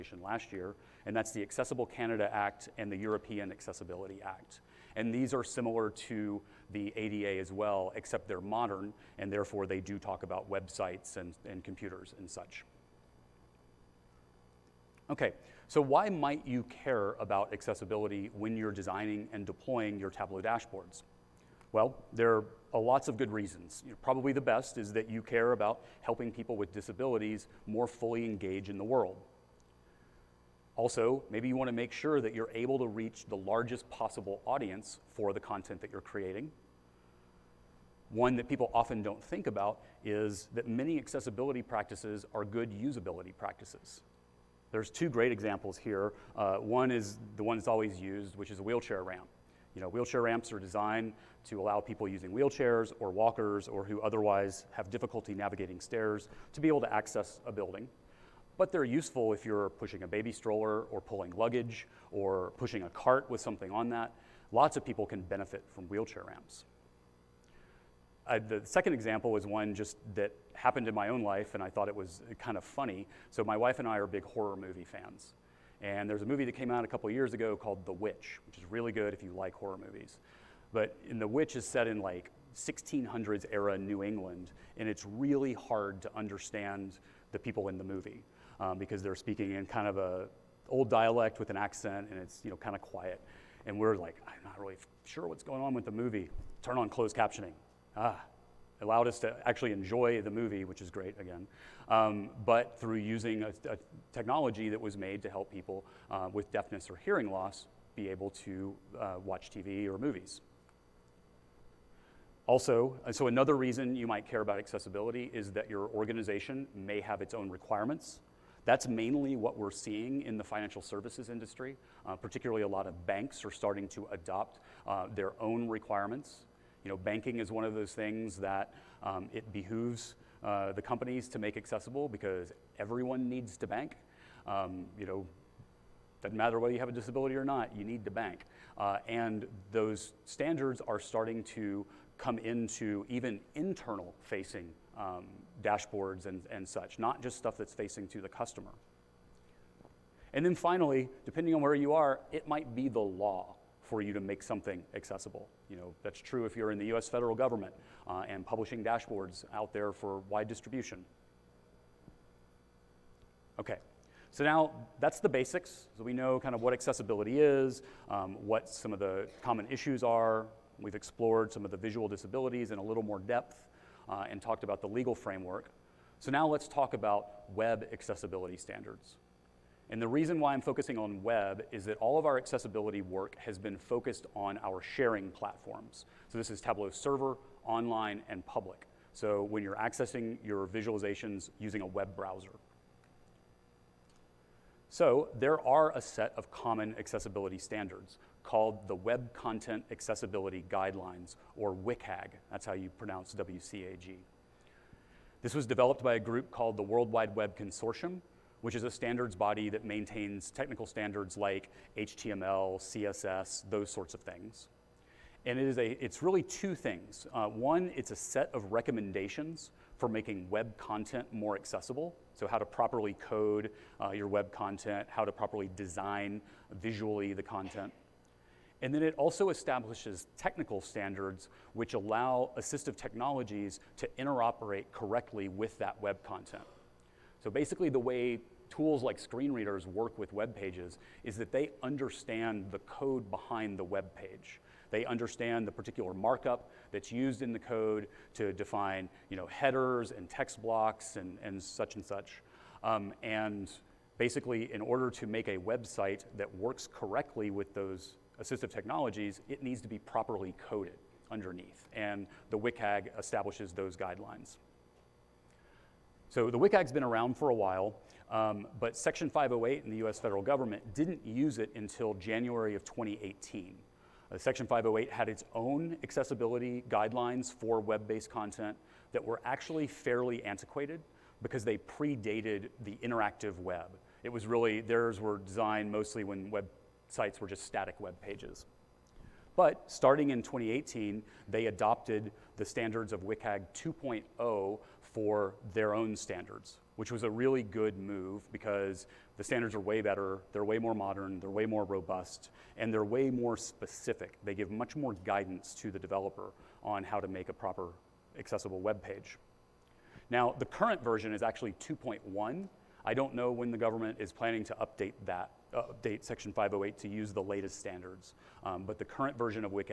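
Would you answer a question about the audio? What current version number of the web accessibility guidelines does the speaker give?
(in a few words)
2.1.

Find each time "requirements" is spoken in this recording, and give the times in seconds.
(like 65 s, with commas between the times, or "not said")
117 s, 125 s.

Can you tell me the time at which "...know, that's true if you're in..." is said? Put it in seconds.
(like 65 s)
155 s.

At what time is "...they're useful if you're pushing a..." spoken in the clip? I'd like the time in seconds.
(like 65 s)
58 s.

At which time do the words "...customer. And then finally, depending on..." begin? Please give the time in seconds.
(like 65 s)
148 s.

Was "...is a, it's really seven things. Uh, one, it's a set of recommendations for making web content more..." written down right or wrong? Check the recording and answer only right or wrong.
wrong.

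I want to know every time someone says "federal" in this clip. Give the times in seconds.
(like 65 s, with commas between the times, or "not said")
157 s, 270 s.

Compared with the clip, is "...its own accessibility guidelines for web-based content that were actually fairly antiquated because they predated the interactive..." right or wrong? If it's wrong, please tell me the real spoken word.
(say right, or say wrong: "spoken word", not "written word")
right.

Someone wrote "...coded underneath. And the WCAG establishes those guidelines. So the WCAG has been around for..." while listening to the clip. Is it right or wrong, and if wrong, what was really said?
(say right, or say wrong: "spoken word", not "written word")
right.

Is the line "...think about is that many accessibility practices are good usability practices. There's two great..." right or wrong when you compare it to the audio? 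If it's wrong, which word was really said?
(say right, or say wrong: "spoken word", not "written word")
right.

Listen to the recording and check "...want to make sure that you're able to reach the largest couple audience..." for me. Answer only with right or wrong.
wrong.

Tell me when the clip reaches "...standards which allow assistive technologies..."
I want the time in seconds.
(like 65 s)
230 s.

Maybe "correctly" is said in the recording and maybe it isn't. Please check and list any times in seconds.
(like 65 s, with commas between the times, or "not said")
234 s, 256 s.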